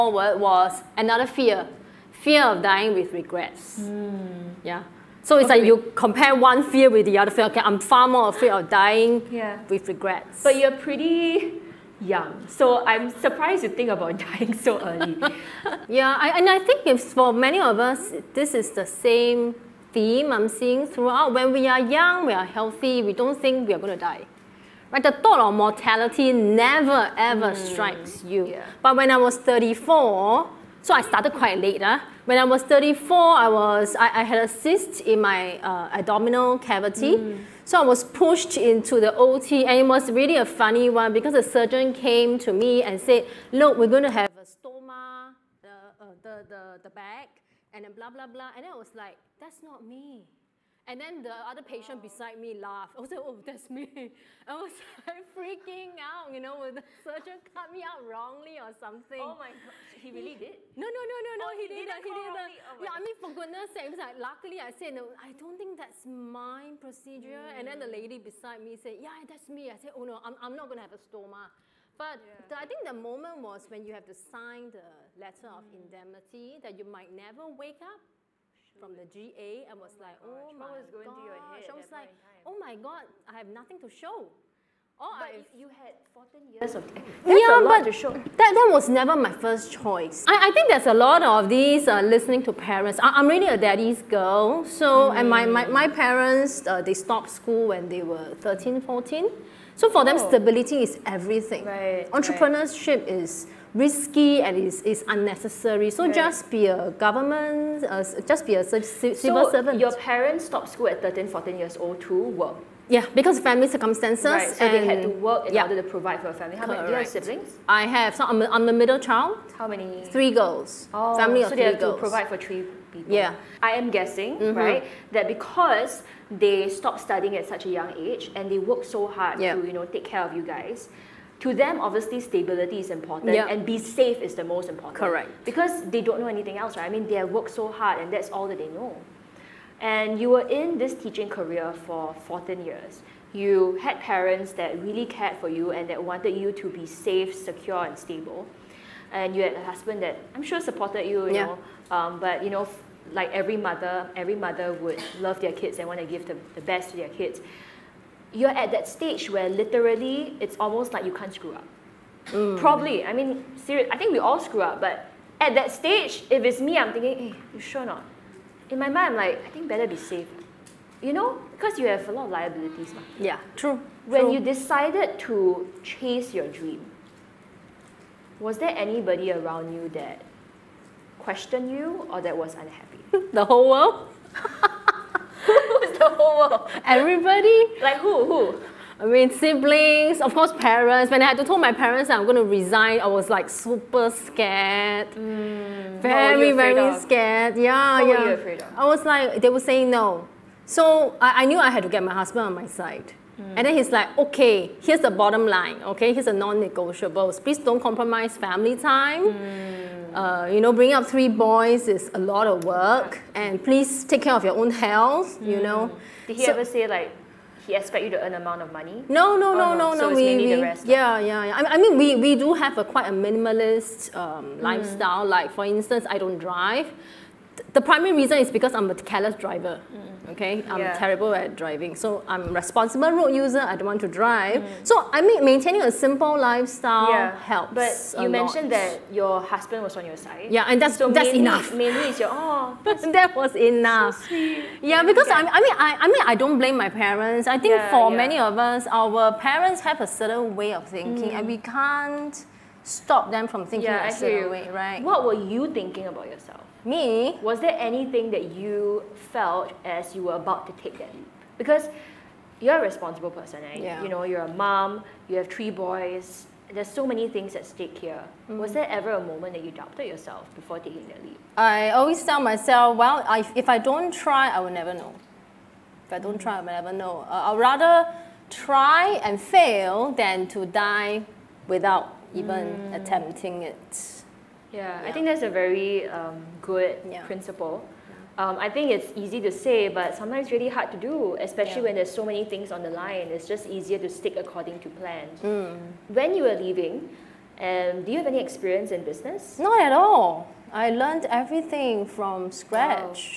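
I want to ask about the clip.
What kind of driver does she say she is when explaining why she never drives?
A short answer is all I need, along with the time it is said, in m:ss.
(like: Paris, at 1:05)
Careless driver, at 3:48.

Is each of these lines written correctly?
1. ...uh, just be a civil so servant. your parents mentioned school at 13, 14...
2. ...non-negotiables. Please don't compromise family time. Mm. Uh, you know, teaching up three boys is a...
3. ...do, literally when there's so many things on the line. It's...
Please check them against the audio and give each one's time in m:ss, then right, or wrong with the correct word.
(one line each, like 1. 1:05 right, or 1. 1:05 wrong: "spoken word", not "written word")
1. 1:47 wrong: "stopped", not "mentioned"
2. 3:26 wrong: "bringing", not "teaching"
3. 4:50 wrong: "especially", not "literally".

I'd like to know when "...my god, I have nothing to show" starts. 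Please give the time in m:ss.
1:22.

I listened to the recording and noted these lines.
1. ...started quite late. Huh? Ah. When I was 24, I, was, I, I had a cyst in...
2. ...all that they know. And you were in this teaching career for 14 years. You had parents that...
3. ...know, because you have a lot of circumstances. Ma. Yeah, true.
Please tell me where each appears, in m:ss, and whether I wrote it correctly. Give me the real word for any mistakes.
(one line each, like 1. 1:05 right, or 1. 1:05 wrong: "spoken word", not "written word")
1. 0:31 wrong: "34", not "24"
2. 2:18 right
3. 2:51 wrong: "liabilities", not "circumstances".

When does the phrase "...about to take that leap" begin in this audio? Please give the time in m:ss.
4:20.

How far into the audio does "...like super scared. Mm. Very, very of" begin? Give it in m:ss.
3:13.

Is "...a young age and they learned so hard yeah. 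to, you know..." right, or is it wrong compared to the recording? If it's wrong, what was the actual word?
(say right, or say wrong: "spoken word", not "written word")
wrong: "worked", not "learned".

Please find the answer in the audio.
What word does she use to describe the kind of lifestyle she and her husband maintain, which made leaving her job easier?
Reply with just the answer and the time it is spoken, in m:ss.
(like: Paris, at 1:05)
Minimalist, at 3:43.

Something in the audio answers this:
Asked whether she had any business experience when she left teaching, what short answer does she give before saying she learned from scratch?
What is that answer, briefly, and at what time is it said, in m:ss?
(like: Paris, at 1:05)
Not at all, at 4:59.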